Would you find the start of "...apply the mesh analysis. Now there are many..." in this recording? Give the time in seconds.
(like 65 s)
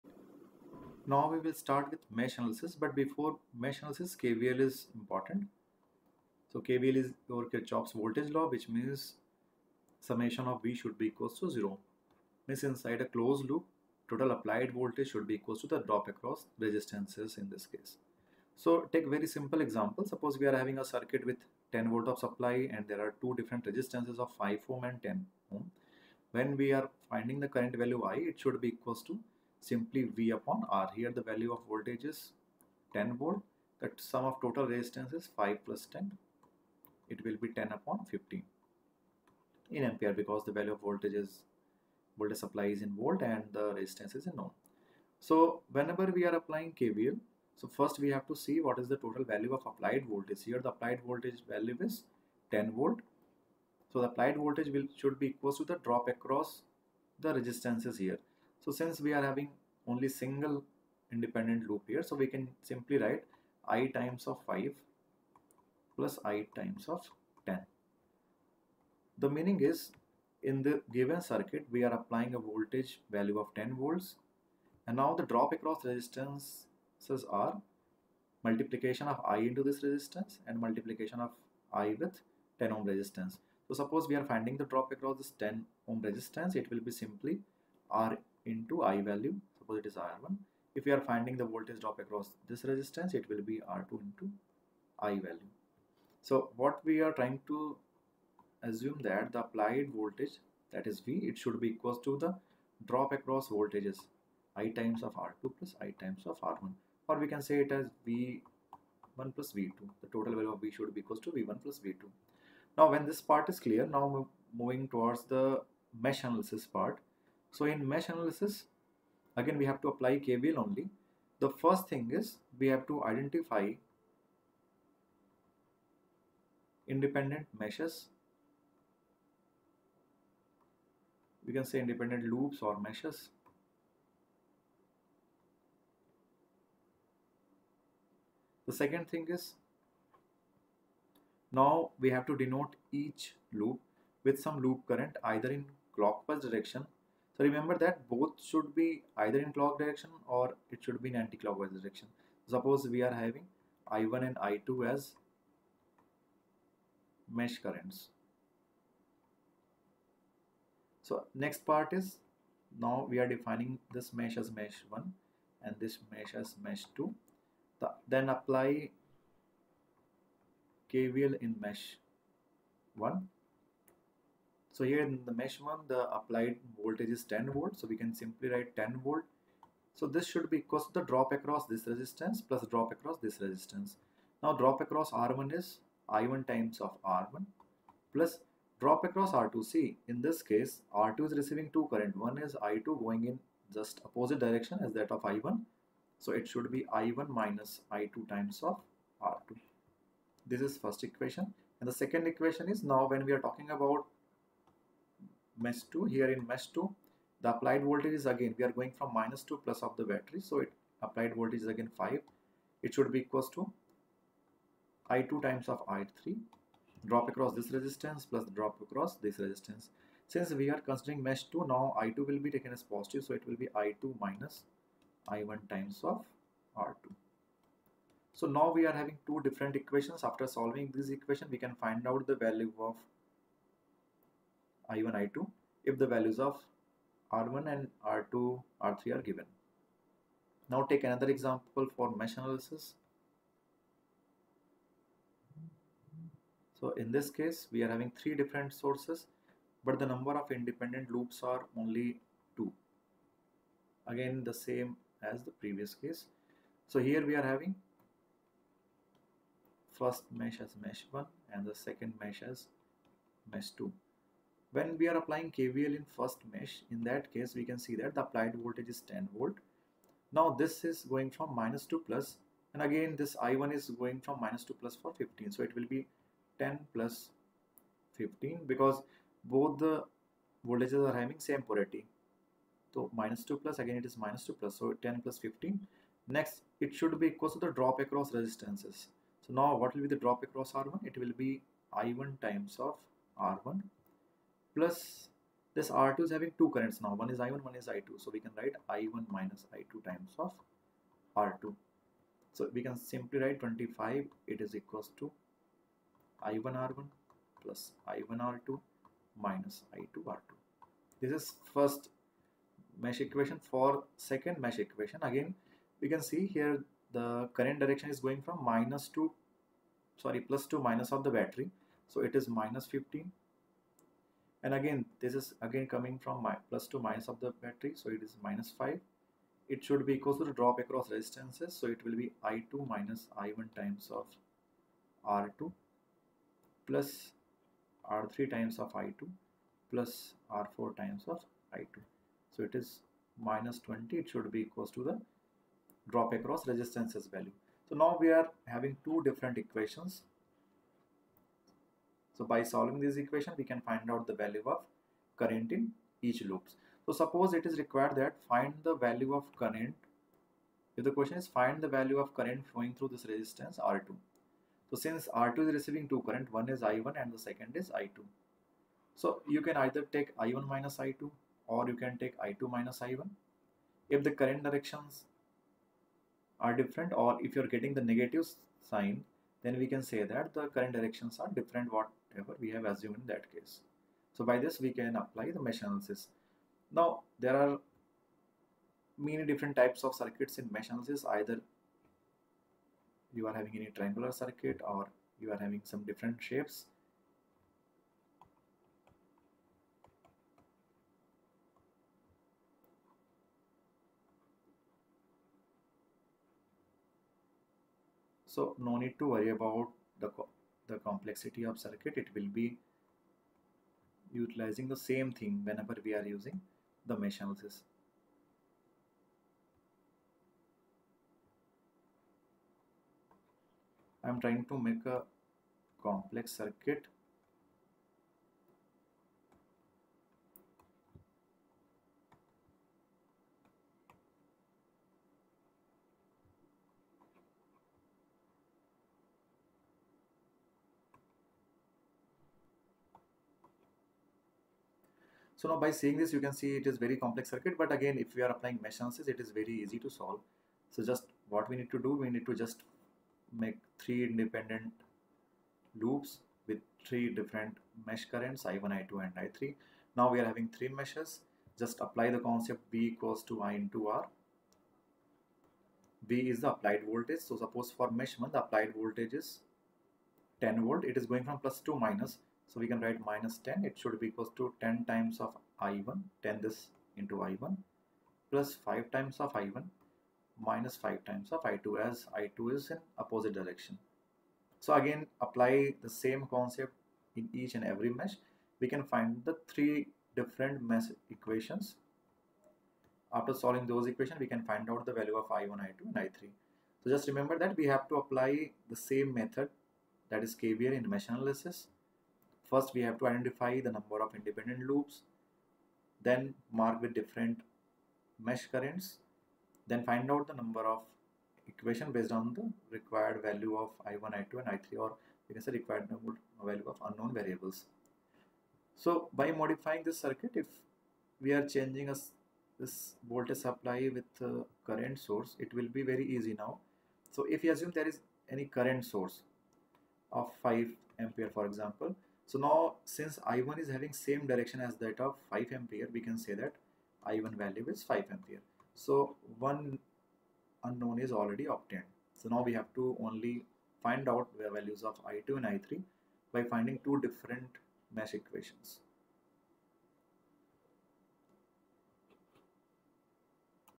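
385 s.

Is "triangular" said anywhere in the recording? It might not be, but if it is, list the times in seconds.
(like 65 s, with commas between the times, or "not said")
393 s.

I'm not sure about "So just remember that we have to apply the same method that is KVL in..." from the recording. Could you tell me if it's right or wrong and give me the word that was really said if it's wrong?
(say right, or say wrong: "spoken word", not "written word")
right.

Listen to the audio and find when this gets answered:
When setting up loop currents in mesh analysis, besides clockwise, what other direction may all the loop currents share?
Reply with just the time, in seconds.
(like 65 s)
151 s.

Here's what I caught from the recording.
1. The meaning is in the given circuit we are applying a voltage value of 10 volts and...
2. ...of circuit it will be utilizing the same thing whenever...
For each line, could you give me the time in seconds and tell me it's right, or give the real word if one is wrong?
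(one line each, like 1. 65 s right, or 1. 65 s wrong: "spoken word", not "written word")
1. 69 s right
2. 411 s right.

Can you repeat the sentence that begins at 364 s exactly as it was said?
So since R2 is receiving two current, one is I1 and the second is I2.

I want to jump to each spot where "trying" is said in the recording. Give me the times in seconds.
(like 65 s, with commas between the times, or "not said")
97 s, 424 s.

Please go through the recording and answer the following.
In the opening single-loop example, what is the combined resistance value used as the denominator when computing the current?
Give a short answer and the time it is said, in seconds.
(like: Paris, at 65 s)
15 ohm, at 35 s.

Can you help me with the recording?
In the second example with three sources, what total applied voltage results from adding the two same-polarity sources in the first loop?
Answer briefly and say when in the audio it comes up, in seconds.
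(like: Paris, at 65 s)
25, at 303 s.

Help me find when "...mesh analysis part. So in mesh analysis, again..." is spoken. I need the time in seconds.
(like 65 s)
115 s.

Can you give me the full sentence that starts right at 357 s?
So suppose it is required that find the value of current.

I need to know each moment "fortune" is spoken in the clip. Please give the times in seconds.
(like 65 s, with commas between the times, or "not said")
not said.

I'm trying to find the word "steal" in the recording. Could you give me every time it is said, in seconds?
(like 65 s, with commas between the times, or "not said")
not said.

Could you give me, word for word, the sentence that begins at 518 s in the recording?
So by modifying this circuit, if we are changing a, this voltage supply with current source, it will be very easy now.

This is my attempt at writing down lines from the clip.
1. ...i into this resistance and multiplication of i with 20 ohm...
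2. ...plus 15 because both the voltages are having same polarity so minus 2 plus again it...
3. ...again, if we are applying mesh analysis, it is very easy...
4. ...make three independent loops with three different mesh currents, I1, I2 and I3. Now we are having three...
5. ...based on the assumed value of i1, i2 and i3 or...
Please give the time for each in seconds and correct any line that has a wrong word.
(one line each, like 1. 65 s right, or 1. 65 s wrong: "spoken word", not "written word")
1. 79 s wrong: "10", not "20"
2. 276 s right
3. 447 s right
4. 453 s right
5. 512 s wrong: "required", not "assumed".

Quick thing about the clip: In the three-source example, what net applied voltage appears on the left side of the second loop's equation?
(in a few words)
-20.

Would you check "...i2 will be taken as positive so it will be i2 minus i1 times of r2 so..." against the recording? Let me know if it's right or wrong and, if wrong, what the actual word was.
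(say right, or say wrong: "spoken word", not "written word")
right.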